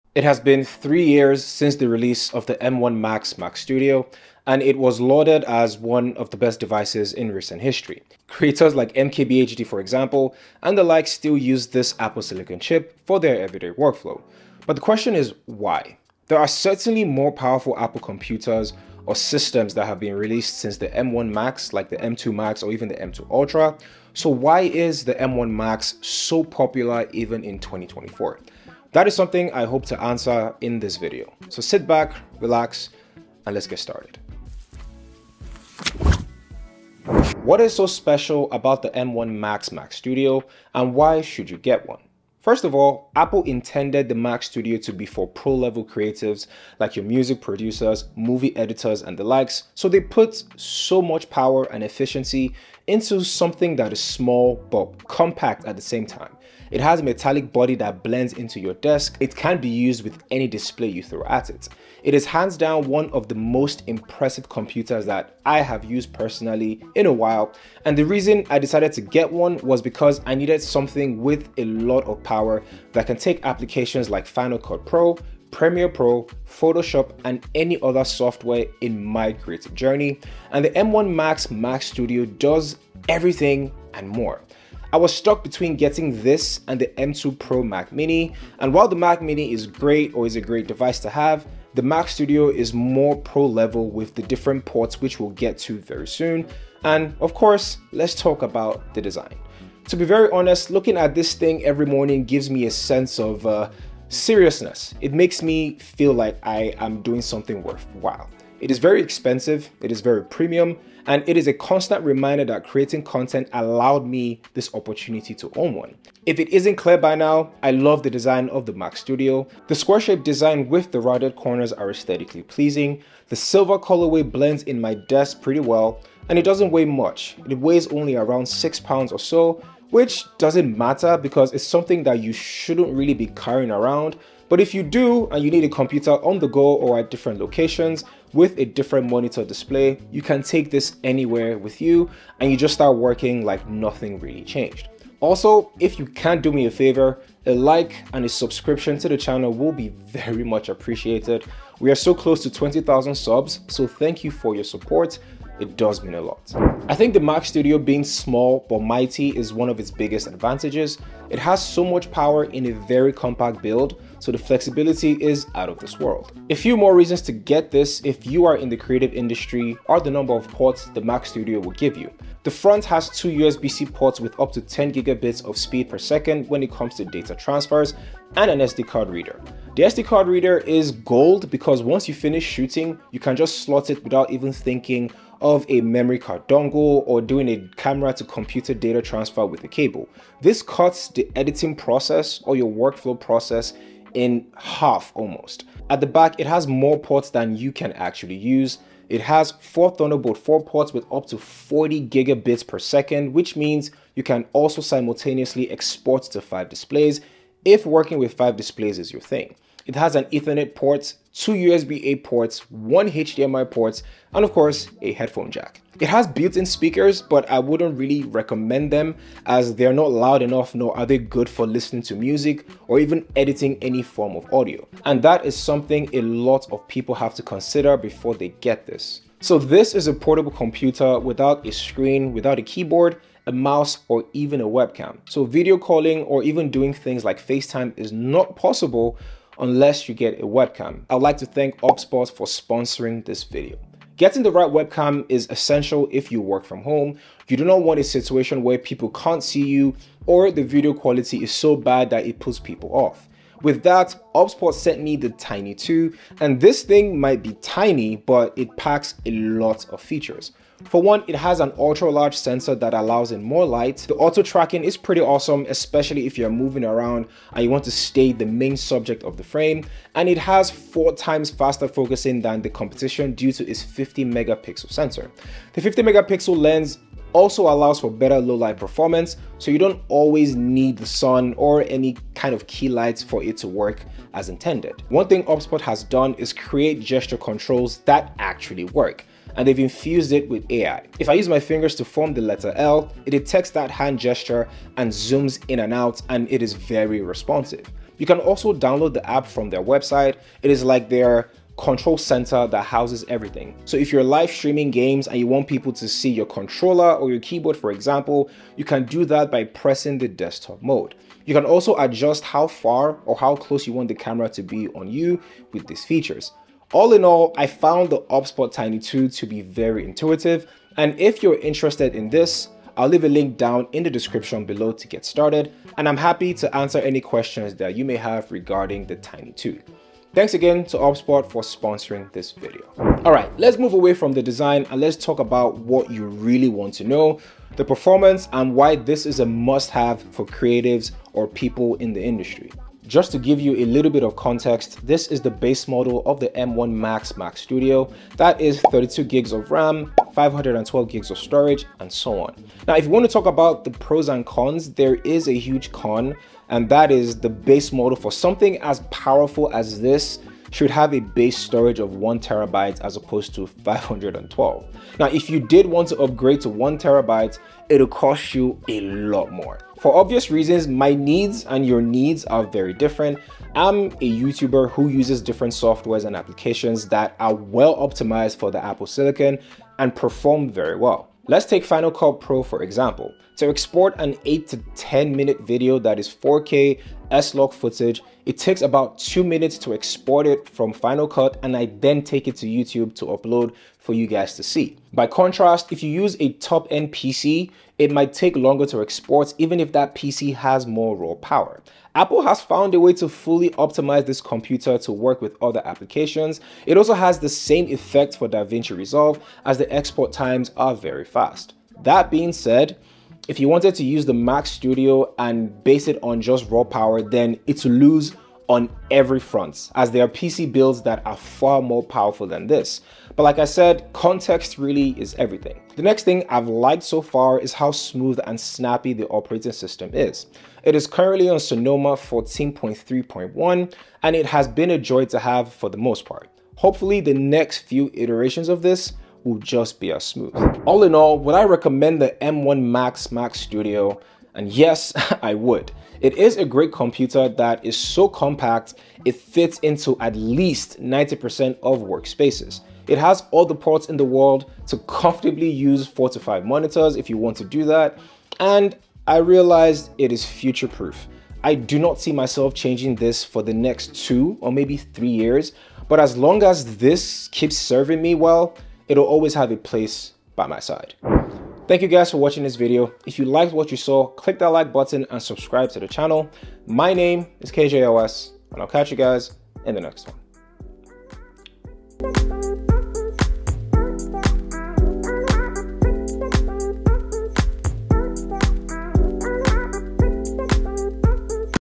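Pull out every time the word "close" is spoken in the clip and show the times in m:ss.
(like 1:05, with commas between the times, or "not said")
2:32, 5:13.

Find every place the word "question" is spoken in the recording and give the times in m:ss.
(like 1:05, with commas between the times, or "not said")
0:14, 5:27.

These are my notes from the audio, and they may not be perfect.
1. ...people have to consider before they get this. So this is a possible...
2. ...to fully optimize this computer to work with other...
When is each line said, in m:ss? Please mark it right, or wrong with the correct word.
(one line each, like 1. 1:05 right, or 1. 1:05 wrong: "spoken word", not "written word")
1. 3:46 wrong: "portable", not "possible"
2. 6:43 right.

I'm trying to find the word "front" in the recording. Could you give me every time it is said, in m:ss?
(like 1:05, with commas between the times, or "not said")
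2:52, 6:59.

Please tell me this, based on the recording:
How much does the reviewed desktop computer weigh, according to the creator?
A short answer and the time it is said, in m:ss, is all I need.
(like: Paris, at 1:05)
6 pounds, at 2:08.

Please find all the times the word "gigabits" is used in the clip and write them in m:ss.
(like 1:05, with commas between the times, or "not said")
2:54, 3:22.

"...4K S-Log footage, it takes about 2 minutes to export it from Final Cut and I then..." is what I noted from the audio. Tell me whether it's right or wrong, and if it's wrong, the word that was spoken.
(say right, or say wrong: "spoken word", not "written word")
right.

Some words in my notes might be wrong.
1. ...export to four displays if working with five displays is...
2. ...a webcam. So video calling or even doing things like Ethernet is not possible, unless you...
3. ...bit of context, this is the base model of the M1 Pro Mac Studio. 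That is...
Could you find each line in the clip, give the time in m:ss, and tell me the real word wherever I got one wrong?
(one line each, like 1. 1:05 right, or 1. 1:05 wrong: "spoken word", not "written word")
1. 3:25 wrong: "five", not "four"
2. 3:54 wrong: "FaceTime", not "Ethernet"
3. 5:44 wrong: "Max", not "Pro".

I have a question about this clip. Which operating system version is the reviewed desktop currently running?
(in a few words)
Sonoma 14.3.1.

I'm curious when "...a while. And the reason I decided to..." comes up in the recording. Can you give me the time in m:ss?
1:07.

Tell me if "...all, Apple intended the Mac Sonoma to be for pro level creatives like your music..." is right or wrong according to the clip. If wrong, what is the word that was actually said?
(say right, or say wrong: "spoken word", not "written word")
wrong: "Studio", not "Sonoma".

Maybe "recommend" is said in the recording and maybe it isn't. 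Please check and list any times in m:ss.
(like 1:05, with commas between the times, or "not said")
3:38, 7:21.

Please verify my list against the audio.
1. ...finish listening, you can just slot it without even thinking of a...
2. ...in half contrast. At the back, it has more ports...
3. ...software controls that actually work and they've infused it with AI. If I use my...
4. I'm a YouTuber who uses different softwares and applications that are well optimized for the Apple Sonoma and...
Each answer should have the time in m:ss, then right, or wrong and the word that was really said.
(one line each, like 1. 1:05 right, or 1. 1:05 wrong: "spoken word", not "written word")
1. 3:02 wrong: "shooting", not "listening"
2. 3:14 wrong: "almost", not "contrast"
3. 4:46 wrong: "gesture", not "software"
4. 6:13 wrong: "Silicon", not "Sonoma".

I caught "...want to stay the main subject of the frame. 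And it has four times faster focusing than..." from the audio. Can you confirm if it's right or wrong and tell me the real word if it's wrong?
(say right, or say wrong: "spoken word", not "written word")
right.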